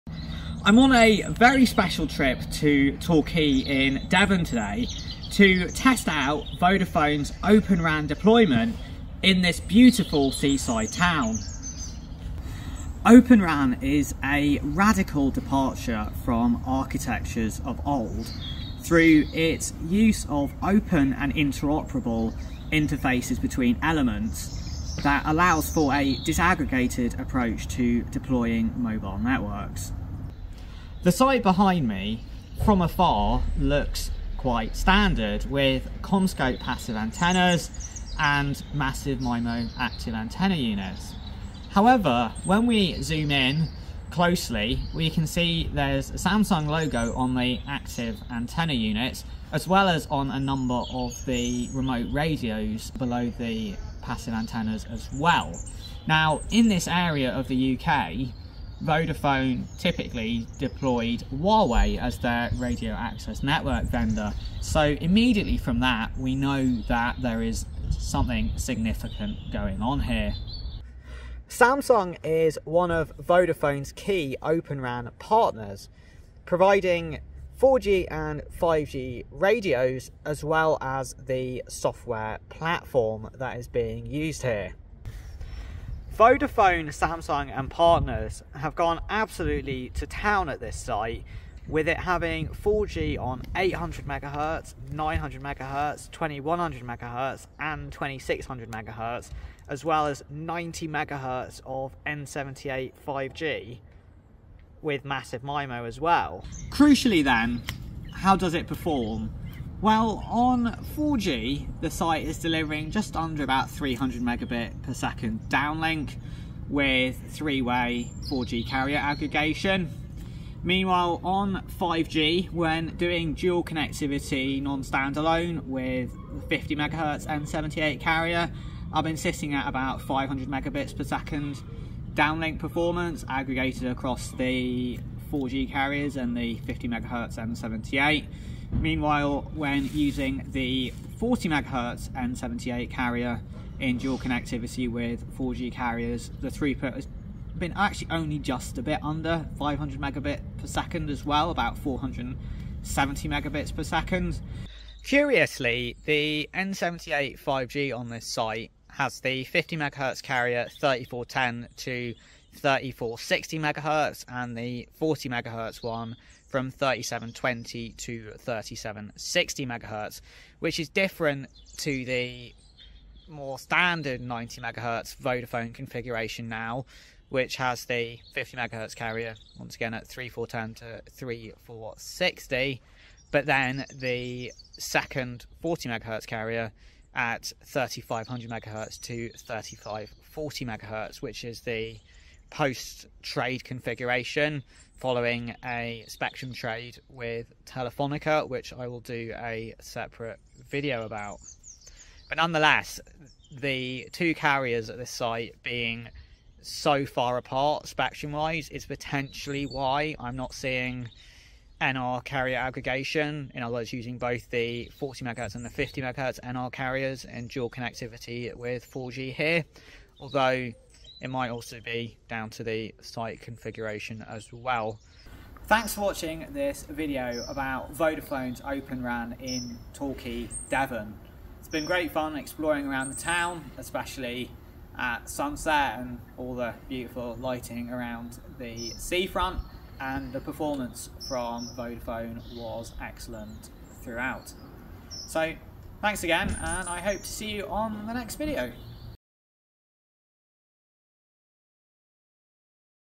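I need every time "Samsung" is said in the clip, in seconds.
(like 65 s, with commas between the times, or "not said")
46 s, 71 s, 86 s.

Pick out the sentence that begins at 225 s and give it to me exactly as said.
Thanks for watching this video about Vodafone's Open RAN in Torquay, Devon.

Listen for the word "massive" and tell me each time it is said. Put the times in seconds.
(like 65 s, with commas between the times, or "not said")
38 s, 105 s.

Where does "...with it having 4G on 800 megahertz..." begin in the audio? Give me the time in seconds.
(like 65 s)
91 s.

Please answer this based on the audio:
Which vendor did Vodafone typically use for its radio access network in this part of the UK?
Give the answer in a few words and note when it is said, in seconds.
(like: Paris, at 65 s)
Huawei, at 61 s.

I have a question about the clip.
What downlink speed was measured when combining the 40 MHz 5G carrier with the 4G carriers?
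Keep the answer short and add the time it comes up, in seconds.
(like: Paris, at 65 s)
470 megabits per second, at 151 s.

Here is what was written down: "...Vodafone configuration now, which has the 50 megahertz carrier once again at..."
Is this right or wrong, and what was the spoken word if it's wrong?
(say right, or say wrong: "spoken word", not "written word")
right.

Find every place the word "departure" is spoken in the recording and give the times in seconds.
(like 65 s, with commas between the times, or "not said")
15 s.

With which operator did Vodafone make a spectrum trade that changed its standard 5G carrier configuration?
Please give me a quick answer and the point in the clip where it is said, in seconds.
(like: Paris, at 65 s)
Telefonica, at 197 s.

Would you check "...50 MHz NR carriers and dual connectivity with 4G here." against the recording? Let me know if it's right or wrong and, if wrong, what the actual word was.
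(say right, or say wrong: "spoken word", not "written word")
right.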